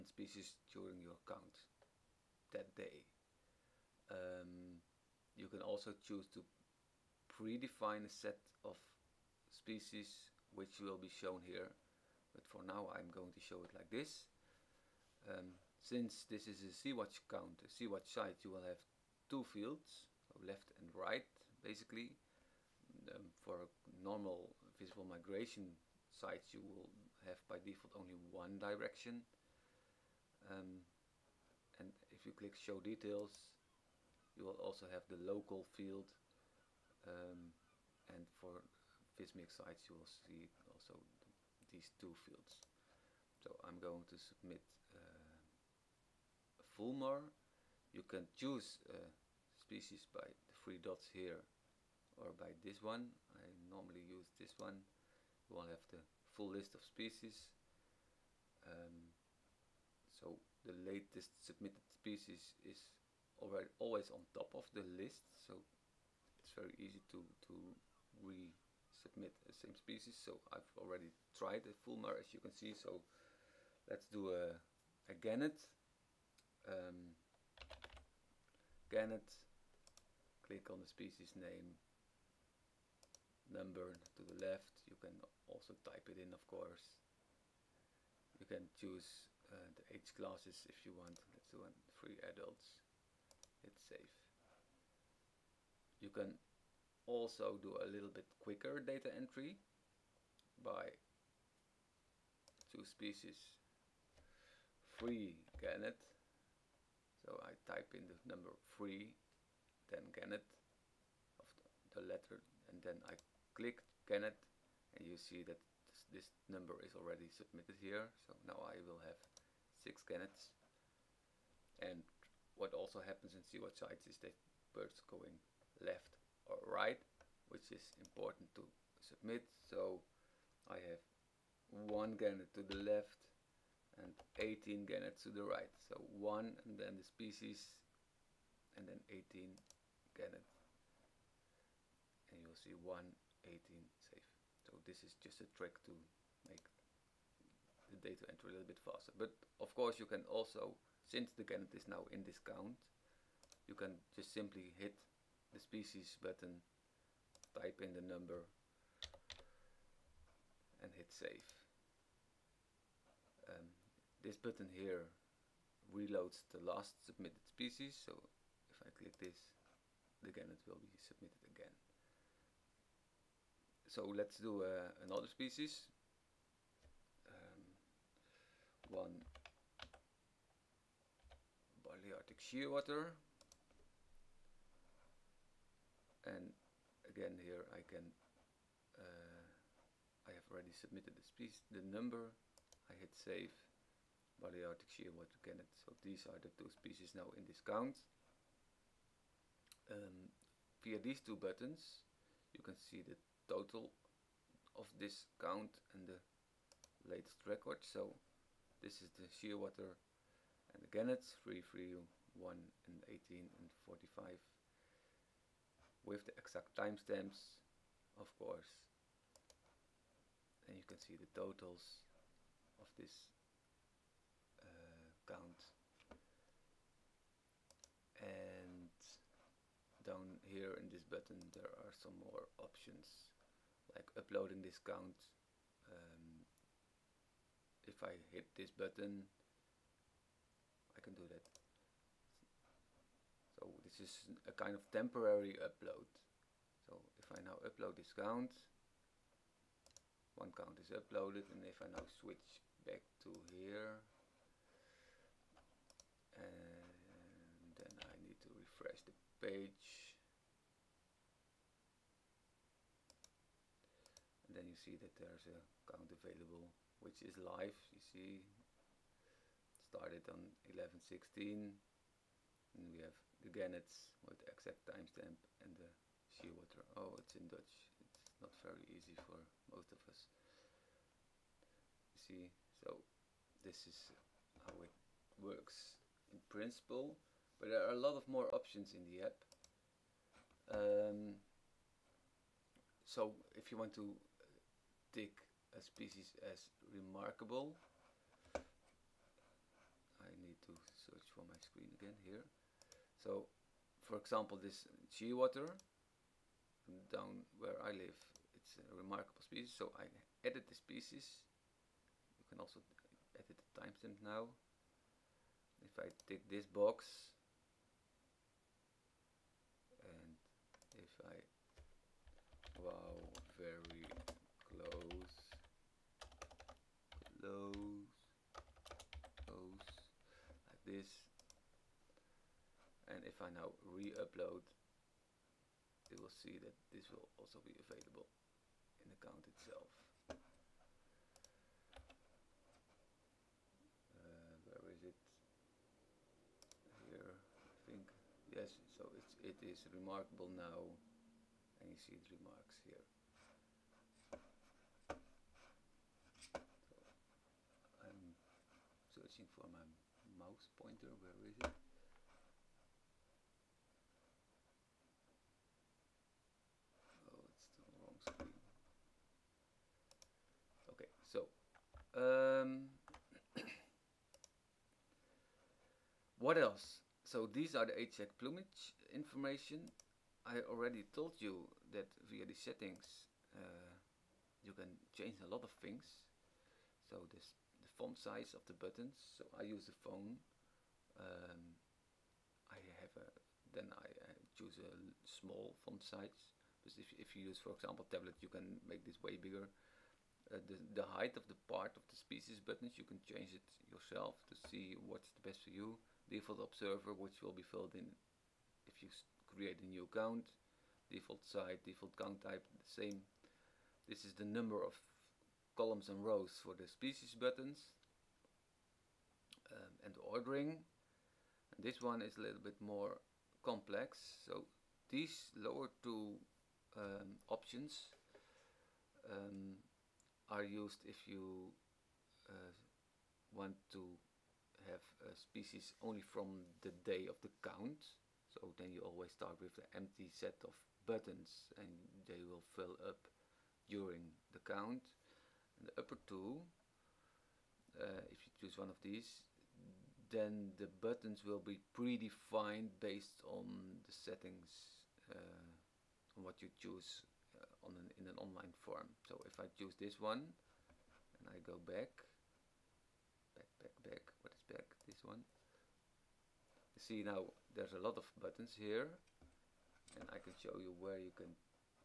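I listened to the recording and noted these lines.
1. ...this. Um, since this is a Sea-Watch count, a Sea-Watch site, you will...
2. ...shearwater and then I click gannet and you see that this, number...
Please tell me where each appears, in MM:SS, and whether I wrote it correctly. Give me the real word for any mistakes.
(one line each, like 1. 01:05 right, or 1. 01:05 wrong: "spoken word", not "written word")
1. 00:13 right
2. 01:52 wrong: "letter", not "shearwater".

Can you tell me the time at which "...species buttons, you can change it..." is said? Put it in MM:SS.
06:42.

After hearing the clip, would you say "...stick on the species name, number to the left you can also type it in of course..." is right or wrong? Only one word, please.
wrong.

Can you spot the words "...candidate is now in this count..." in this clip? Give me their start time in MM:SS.
02:31.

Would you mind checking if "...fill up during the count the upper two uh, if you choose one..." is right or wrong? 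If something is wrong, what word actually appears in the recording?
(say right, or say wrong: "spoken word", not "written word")
right.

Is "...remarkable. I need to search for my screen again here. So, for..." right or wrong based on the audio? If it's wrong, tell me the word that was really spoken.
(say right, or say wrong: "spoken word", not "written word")
right.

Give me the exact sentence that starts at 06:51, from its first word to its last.
Default site, default count type, the same.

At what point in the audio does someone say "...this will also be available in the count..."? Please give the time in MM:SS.
05:36.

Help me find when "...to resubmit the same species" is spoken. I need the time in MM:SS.
01:07.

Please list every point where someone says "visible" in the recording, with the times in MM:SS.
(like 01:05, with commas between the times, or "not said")
00:24.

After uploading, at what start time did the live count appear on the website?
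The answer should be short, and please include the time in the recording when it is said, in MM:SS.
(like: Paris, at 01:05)
11.16, at 04:30.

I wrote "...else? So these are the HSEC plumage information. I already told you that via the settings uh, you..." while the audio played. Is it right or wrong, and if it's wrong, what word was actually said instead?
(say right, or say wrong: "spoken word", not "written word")
right.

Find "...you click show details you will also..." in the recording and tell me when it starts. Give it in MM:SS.
00:32.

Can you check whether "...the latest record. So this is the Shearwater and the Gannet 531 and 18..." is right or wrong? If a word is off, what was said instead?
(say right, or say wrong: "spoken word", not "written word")
wrong: "331", not "531".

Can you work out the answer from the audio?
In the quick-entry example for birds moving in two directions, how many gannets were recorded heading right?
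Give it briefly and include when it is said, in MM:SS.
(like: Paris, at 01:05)
18, at 02:14.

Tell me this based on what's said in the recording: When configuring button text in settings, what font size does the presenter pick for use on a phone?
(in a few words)
Small.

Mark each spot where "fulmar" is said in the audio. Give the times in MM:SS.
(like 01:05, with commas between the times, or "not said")
00:46, 01:11.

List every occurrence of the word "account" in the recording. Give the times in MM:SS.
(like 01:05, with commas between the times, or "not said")
04:25, 06:50.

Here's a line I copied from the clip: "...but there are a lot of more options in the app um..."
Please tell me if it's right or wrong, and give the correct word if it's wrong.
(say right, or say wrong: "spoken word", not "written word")
right.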